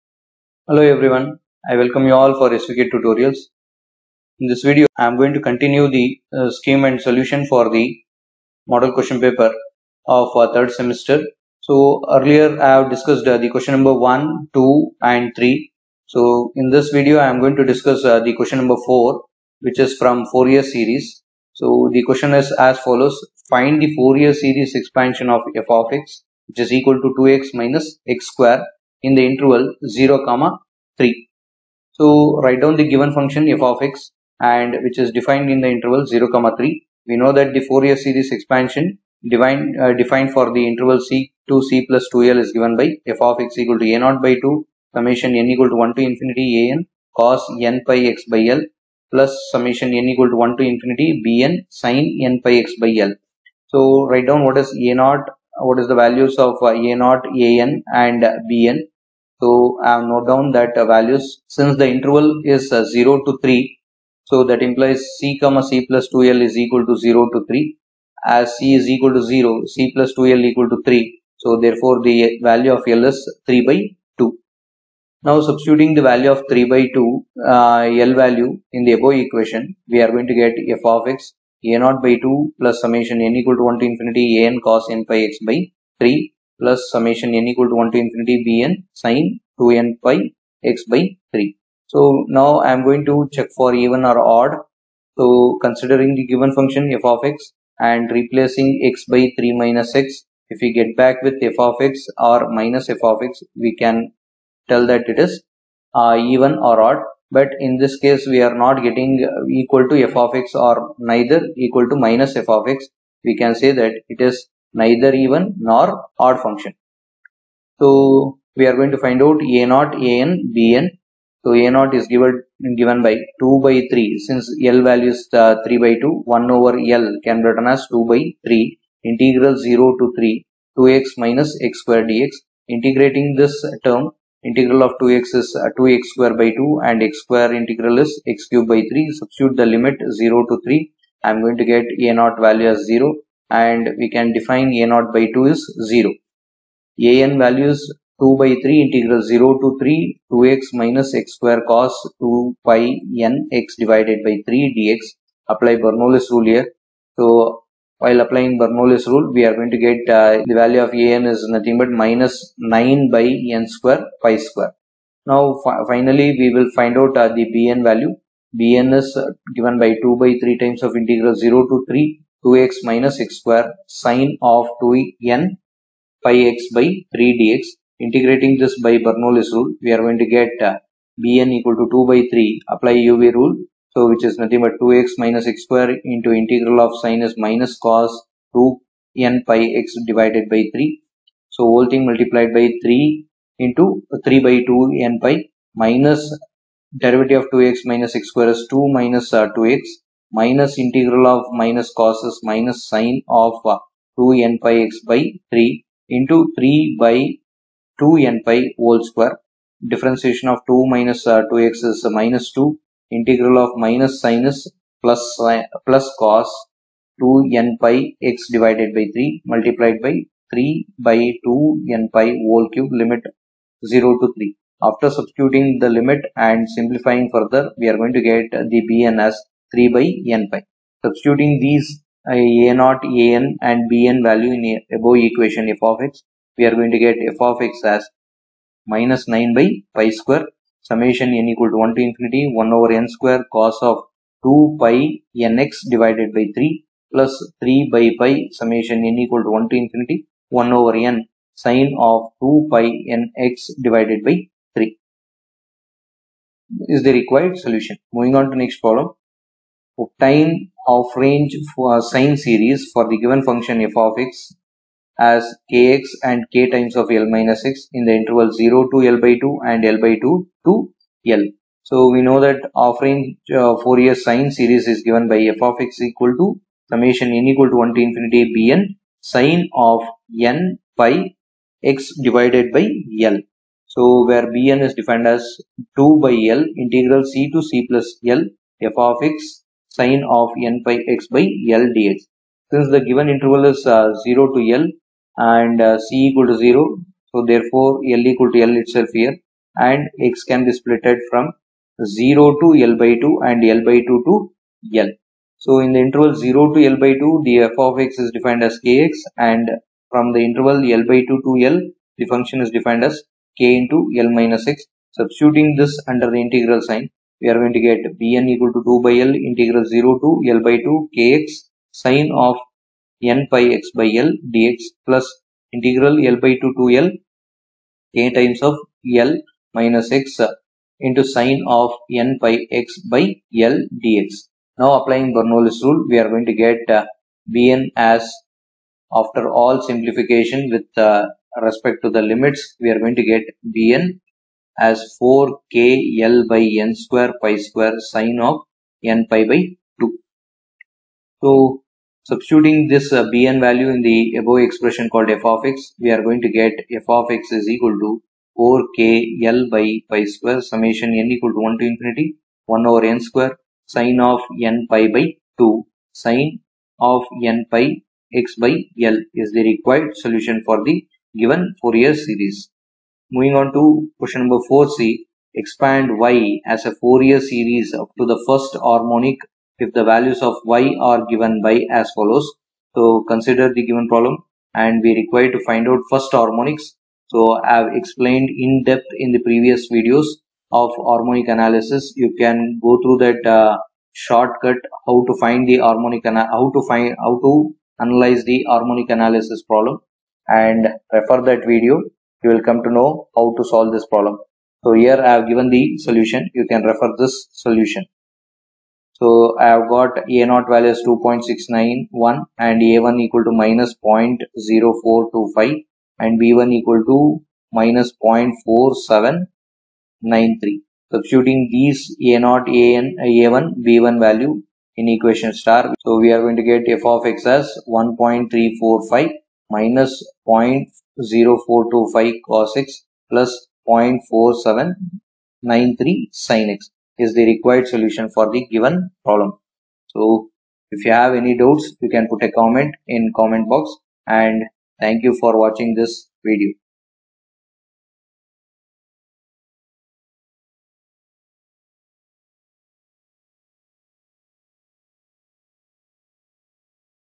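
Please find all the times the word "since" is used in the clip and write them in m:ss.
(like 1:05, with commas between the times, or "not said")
1:01, 2:04, 4:52.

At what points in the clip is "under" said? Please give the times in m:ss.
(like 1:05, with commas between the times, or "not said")
5:16.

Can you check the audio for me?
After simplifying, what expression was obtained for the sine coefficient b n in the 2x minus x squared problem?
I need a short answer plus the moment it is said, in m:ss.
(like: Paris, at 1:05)
3/(nπ), at 3:49.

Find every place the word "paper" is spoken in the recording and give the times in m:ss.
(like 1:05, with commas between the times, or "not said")
0:09.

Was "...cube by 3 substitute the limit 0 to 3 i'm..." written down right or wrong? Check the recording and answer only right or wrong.
right.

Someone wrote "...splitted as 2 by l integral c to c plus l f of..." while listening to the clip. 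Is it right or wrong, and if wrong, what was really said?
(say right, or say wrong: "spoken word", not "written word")
wrong: "defined", not "splitted".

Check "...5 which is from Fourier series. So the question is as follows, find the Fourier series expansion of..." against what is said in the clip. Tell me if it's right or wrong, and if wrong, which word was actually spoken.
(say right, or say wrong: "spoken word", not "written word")
wrong: "4", not "5".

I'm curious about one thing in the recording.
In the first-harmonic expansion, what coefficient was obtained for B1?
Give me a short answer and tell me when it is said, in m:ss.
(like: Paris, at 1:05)
-0.4793, at 6:57.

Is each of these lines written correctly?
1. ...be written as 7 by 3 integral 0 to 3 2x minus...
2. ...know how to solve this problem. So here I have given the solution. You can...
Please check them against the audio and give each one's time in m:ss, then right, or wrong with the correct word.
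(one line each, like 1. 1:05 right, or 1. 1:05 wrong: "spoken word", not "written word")
1. 2:07 wrong: "2", not "7"
2. 6:42 right.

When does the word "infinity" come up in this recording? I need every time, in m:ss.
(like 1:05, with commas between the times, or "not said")
0:46, 0:50, 1:23, 1:28, 4:02, 4:09, 4:38, 6:01.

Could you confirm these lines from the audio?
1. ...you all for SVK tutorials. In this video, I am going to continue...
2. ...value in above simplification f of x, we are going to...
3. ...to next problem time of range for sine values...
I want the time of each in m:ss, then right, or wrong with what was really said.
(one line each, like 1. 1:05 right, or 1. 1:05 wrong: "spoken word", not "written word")
1. 0:02 right
2. 3:54 wrong: "equation", not "simplification"
3. 4:18 wrong: "series", not "values".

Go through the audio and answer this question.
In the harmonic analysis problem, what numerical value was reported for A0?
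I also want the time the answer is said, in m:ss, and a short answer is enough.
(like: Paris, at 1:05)
2.691, at 6:51.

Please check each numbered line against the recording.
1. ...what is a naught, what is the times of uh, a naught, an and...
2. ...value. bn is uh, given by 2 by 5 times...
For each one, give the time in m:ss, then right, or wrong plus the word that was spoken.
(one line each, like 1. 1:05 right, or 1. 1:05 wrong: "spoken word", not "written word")
1. 0:54 wrong: "values", not "times"
2. 2:47 wrong: "3", not "5".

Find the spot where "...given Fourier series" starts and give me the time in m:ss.
6:11.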